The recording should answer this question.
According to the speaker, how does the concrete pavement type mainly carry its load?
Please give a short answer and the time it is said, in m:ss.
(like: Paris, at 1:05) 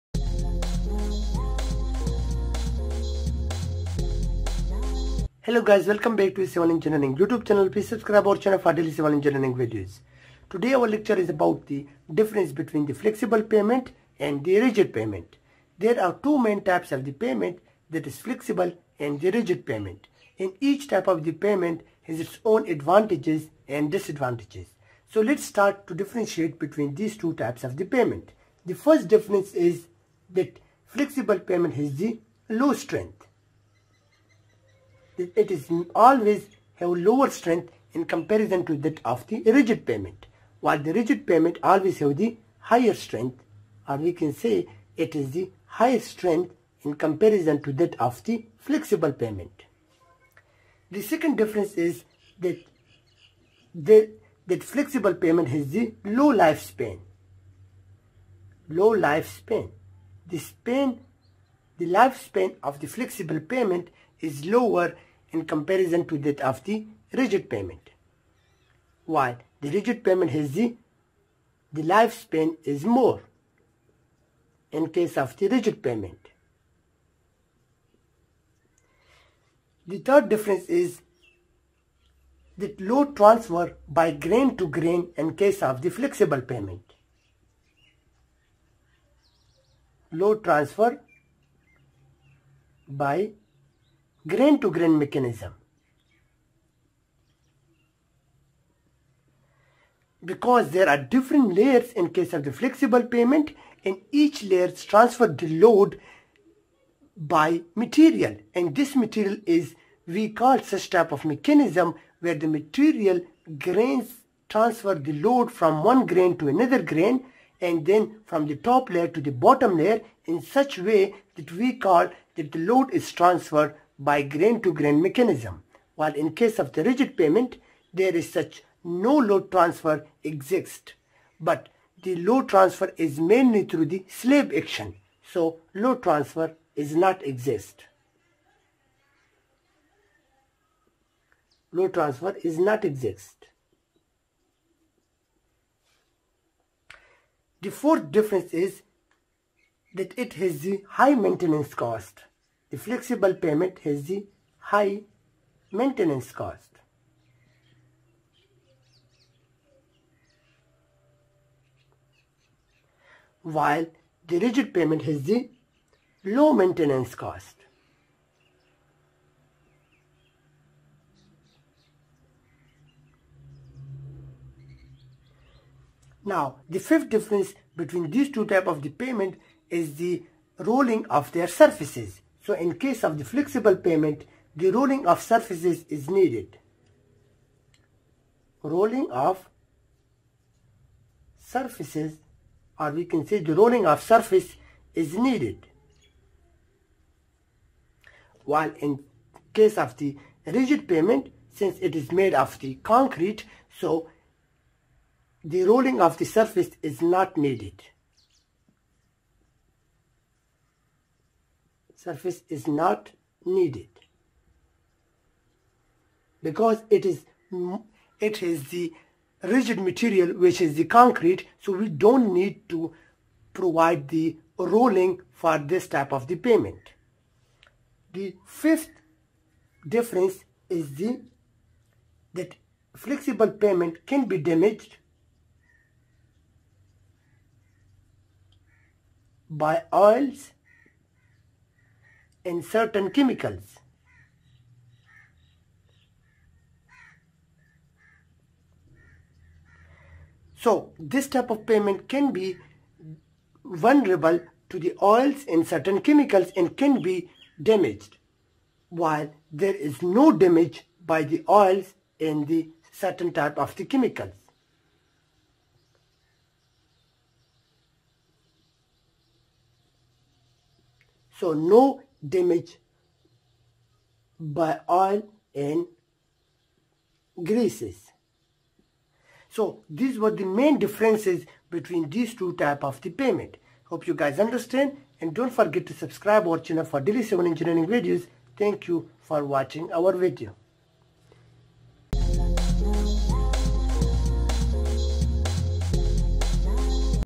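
Slab action, at 2:14.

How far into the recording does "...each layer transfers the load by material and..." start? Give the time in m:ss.
1:44.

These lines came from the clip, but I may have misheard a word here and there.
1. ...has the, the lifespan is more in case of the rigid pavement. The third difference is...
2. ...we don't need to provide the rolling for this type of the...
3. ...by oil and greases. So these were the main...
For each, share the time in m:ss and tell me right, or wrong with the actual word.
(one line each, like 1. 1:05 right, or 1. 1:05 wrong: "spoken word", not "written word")
1. 1:10 right
2. 3:41 right
3. 4:34 right.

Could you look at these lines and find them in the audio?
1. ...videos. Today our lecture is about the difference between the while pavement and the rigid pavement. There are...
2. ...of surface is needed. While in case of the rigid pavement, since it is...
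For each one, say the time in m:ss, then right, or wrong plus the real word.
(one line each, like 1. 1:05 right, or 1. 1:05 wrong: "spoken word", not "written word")
1. 0:09 wrong: "flexible", not "while"
2. 3:13 right.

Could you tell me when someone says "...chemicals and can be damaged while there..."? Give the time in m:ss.
4:16.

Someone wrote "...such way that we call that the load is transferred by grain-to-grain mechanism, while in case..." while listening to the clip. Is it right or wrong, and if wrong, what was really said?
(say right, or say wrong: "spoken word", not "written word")
right.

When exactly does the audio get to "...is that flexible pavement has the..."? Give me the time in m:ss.
0:29.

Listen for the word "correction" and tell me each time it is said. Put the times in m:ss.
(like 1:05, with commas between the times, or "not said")
not said.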